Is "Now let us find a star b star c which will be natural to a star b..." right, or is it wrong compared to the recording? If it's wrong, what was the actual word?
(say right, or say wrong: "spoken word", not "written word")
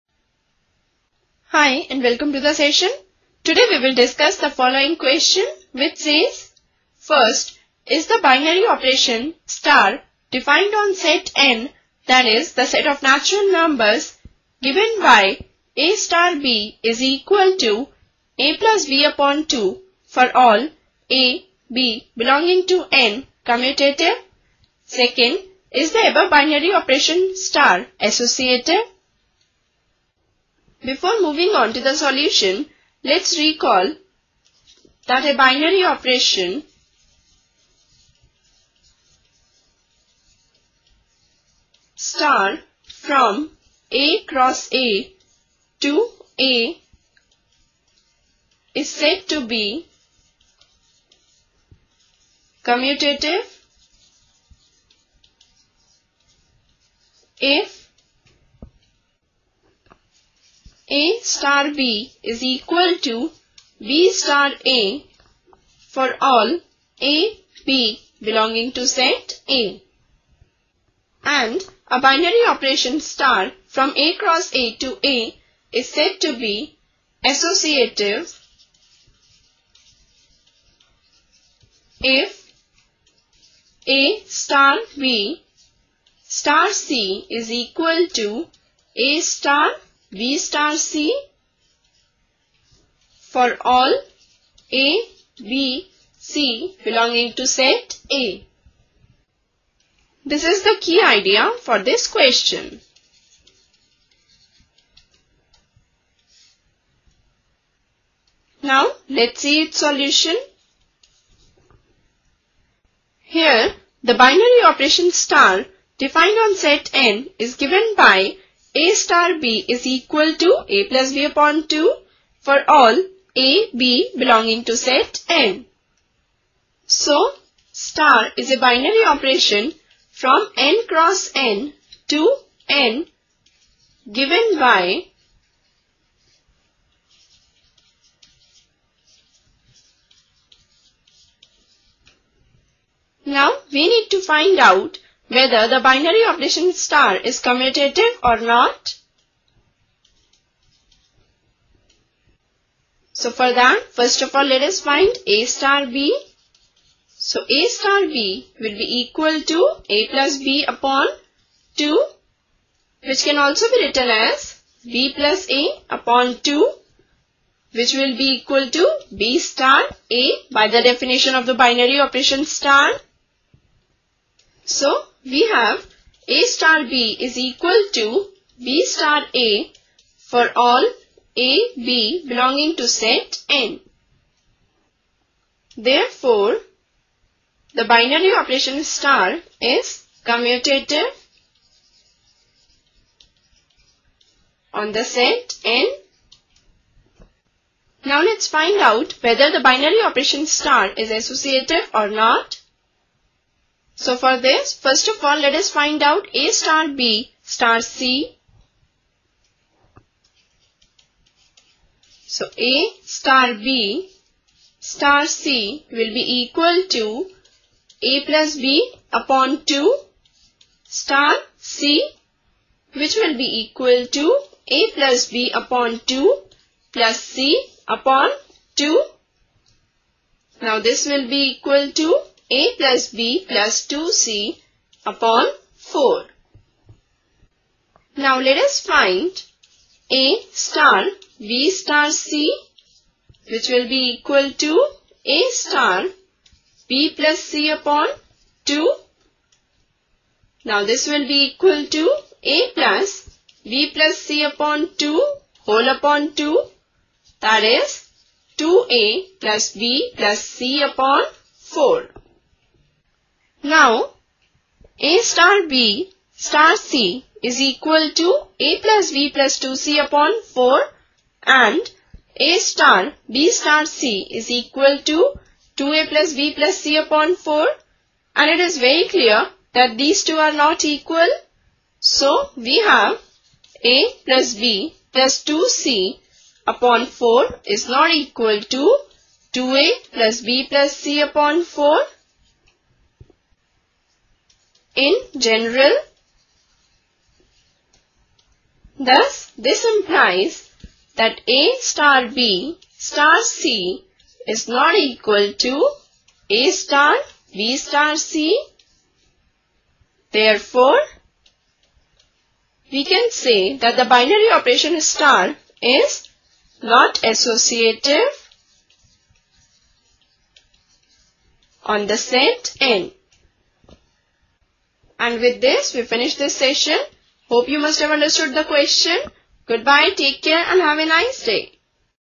wrong: "equal", not "natural".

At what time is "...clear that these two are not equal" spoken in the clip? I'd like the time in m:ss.
4:39.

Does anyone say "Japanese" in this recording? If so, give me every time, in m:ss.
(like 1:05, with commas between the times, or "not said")
not said.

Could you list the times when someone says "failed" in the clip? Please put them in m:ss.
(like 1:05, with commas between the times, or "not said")
not said.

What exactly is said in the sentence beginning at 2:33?
So for that, first of all, let us find A star B.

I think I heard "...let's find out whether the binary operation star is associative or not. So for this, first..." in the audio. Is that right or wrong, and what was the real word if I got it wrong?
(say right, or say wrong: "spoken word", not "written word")
right.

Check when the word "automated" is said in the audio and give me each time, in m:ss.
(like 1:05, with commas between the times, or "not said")
not said.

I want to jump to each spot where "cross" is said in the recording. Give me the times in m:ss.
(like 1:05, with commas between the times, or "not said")
0:44, 1:14, 2:10.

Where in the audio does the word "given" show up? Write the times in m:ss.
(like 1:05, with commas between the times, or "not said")
0:14, 1:57, 2:14.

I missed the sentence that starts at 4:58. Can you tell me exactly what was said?
Thus, this implies that A star B star C is not equal to A star B star C.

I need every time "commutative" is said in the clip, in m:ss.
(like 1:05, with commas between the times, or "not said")
0:23, 0:52, 2:27, 3:10.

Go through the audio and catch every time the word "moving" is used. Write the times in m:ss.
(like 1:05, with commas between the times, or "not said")
0:31.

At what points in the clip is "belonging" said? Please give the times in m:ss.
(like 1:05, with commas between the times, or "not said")
0:22, 1:08, 1:36, 2:04, 3:02.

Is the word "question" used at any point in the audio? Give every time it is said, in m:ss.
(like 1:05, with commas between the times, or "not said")
0:04, 1:42, 5:28.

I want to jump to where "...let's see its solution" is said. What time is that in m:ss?
1:49.